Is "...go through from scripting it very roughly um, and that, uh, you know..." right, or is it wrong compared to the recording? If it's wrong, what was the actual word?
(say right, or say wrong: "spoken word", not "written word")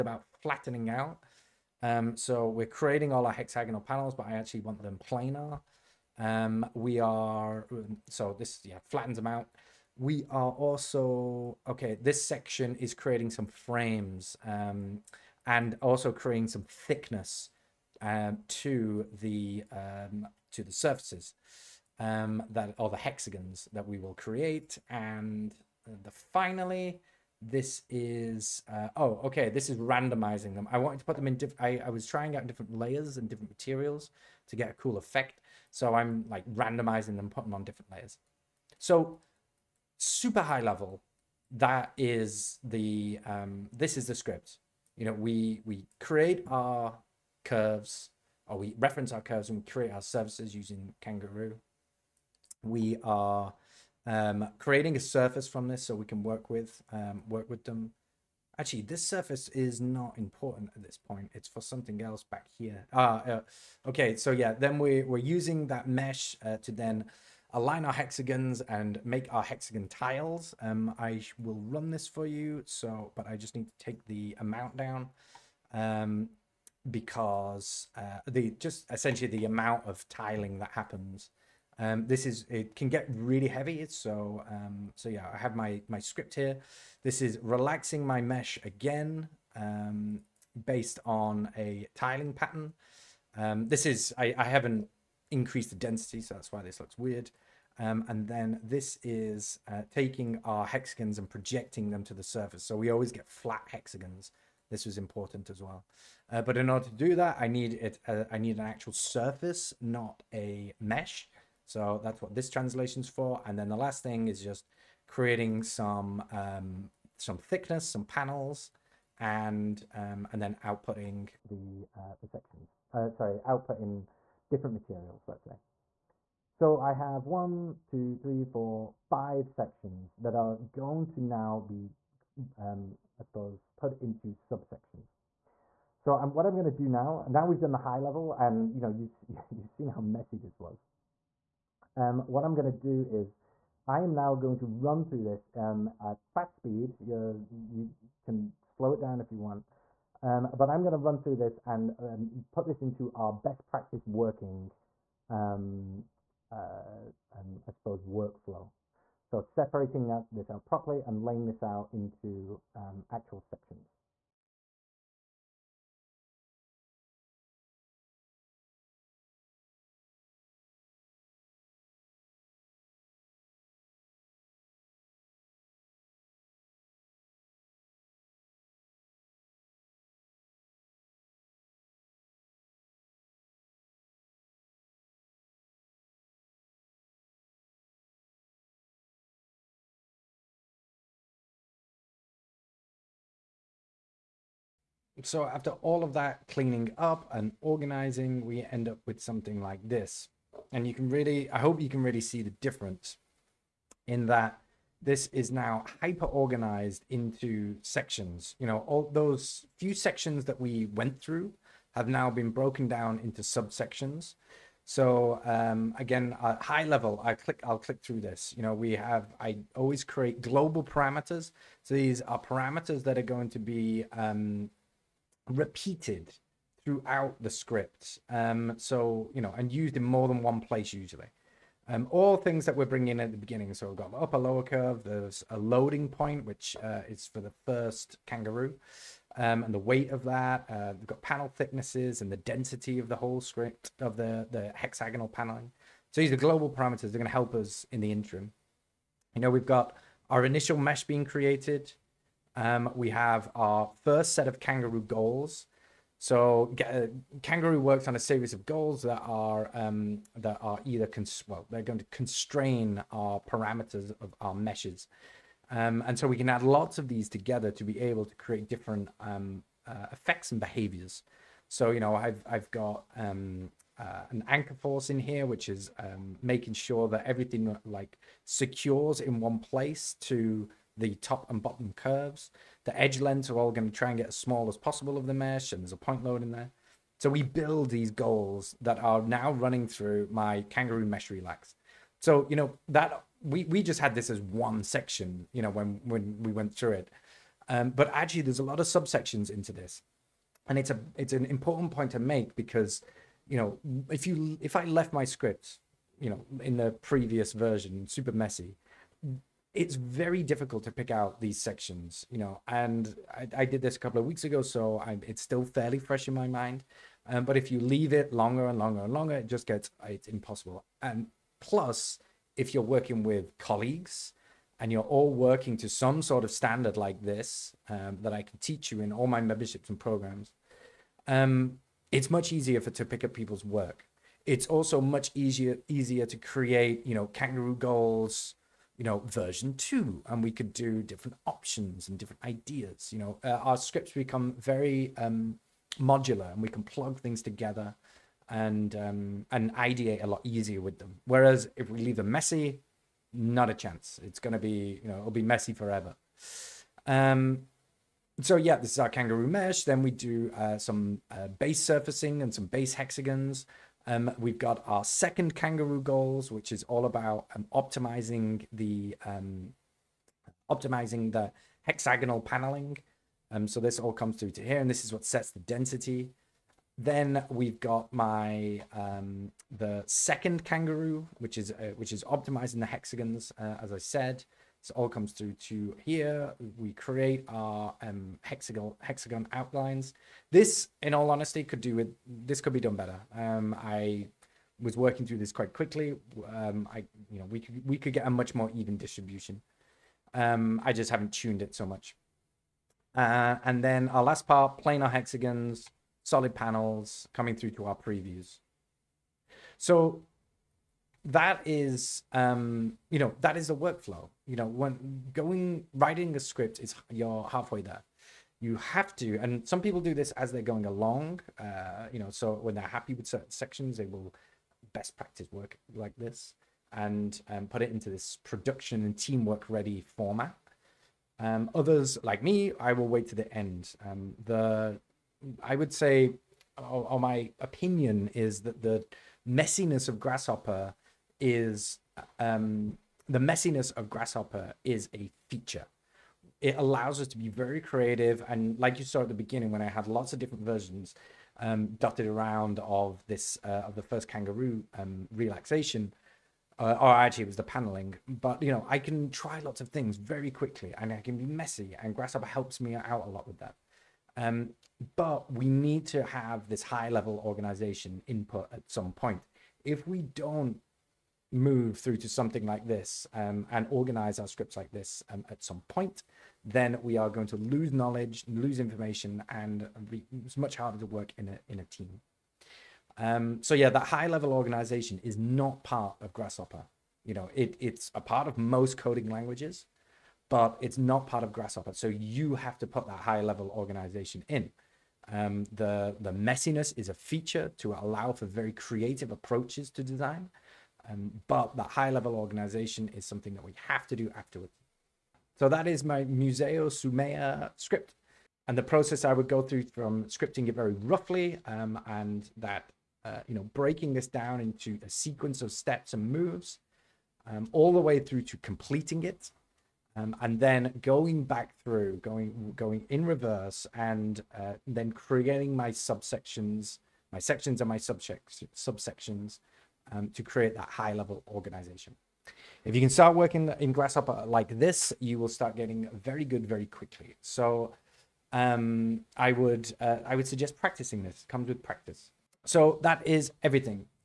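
right.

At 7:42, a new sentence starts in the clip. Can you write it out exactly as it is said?
And Grasshopper helps me out a lot with that.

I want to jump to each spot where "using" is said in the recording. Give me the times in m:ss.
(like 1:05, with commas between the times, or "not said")
0:50, 1:05.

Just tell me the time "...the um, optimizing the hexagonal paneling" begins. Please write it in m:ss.
6:08.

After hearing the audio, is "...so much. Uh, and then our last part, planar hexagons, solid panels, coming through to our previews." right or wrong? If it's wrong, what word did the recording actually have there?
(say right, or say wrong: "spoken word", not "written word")
right.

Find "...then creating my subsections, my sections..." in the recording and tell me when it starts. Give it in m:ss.
8:44.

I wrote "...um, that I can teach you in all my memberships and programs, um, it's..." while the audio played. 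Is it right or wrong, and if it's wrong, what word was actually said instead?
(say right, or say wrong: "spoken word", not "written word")
right.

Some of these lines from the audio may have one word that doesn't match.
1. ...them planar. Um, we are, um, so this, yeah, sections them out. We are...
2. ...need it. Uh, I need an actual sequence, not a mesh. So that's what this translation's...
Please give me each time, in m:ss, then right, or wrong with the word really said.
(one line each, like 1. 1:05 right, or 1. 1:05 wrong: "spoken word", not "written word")
1. 0:04 wrong: "flattens", not "sections"
2. 1:47 wrong: "surface", not "sequence".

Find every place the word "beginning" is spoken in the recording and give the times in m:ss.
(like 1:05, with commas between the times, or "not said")
3:53, 7:29.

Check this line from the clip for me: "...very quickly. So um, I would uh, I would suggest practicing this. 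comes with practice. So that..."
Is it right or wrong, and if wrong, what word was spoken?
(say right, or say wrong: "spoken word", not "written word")
right.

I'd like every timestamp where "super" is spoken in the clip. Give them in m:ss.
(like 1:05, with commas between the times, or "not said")
0:39, 5:08.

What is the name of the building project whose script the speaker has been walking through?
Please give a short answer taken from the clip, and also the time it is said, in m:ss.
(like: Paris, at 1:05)
Museo Soumaya, at 8:26.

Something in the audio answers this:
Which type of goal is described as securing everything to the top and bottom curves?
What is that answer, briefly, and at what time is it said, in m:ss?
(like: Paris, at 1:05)
An anchor force, at 4:34.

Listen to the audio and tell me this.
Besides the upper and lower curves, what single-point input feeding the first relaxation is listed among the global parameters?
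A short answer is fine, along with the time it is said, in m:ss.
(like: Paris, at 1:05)
A loading point, at 3:55.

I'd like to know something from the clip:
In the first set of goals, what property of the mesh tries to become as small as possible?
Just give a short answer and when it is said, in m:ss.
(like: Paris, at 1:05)
Edge lengths, at 4:42.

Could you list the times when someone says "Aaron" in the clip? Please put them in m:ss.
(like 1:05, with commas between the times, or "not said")
not said.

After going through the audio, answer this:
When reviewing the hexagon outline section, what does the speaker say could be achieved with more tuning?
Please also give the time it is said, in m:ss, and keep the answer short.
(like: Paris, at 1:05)
A much more even distribution, at 6:38.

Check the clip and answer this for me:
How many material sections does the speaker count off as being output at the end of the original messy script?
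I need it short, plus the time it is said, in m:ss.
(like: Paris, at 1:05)
5, at 2:09.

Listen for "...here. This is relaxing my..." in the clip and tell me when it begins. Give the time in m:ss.
1:26.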